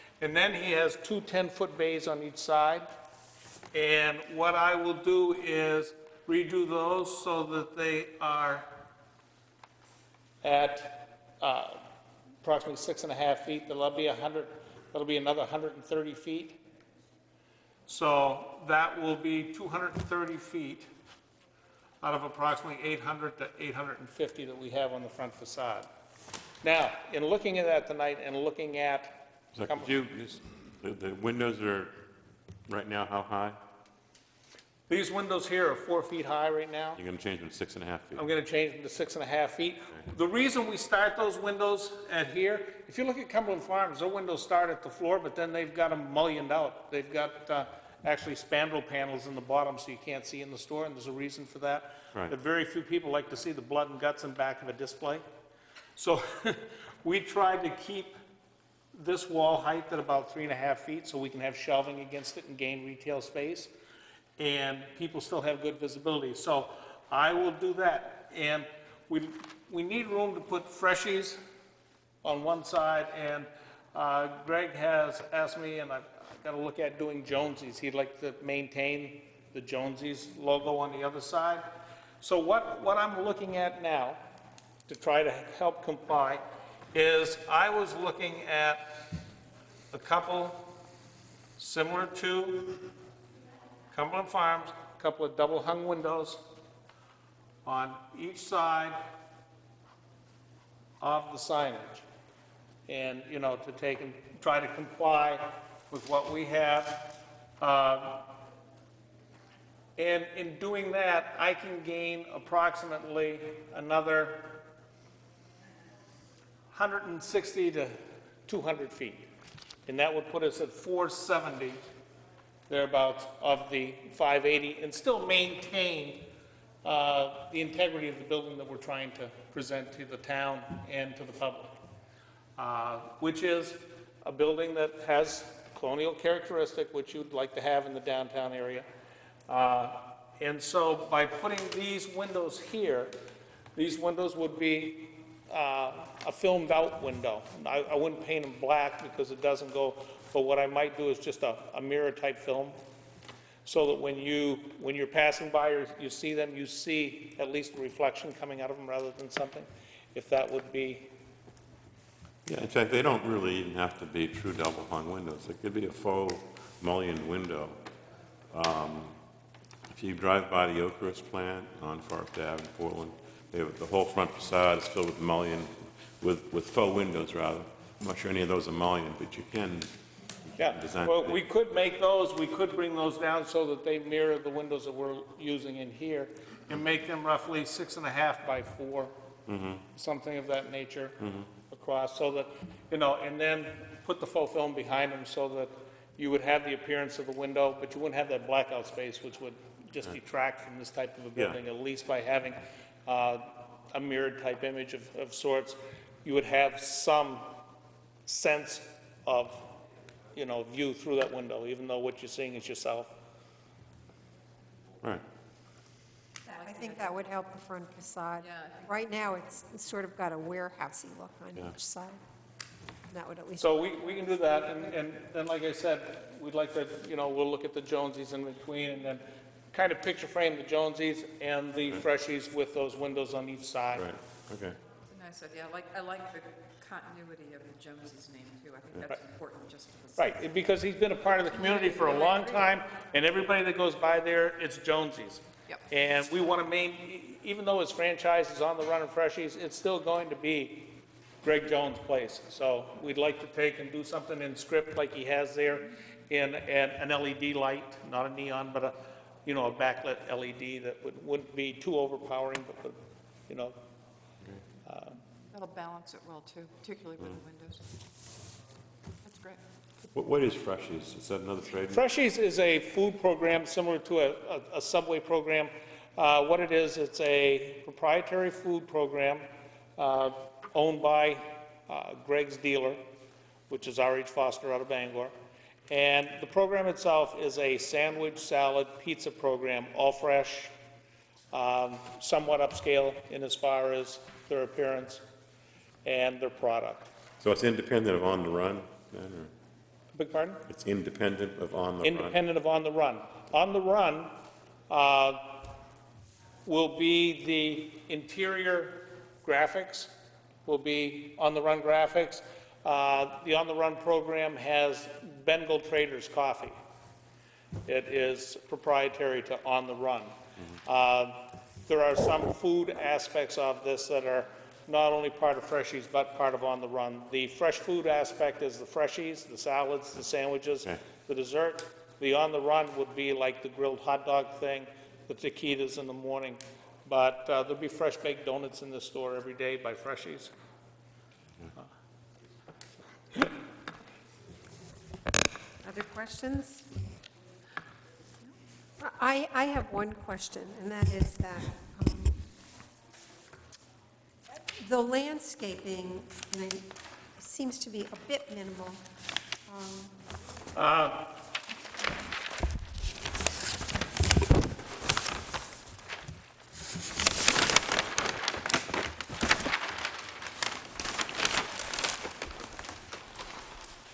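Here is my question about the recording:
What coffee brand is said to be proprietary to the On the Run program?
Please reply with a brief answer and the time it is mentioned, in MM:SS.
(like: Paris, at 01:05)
Bengal Traders, at 05:15.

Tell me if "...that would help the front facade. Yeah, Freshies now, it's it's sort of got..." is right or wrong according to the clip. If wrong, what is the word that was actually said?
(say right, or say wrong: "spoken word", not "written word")
wrong: "Right", not "Freshies".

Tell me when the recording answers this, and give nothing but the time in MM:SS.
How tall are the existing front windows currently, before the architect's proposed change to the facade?
00:35.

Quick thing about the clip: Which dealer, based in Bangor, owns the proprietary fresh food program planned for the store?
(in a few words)
R.H. Foster.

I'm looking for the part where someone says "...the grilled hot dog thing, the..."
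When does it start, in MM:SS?
05:33.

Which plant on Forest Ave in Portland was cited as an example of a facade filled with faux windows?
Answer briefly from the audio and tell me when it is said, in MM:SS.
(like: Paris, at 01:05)
Oakhurst, at 02:50.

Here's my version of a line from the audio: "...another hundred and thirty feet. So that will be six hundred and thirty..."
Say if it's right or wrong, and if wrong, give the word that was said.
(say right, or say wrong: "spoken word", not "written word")
wrong: "two", not "six".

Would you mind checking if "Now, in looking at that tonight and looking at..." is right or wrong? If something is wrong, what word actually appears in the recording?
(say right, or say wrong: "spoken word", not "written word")
right.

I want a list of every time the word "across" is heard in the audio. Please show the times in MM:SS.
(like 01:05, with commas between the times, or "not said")
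03:11.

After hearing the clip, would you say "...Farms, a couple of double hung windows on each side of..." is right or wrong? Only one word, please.
right.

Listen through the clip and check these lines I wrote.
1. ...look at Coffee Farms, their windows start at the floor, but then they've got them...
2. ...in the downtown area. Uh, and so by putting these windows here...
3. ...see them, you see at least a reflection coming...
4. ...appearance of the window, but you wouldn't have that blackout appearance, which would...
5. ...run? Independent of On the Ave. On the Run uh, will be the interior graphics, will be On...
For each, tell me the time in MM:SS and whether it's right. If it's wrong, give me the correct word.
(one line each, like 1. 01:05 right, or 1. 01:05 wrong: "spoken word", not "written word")
1. 00:43 wrong: "Cumberland", not "Coffee"
2. 02:17 right
3. 02:36 right
4. 03:16 wrong: "space", not "appearance"
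5. 05:02 wrong: "Run", not "Ave".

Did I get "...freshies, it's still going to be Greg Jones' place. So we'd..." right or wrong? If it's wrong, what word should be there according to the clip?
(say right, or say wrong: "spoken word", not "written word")
right.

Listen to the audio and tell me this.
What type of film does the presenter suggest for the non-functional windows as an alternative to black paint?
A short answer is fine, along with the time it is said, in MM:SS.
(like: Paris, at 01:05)
mirror-type film, at 02:31.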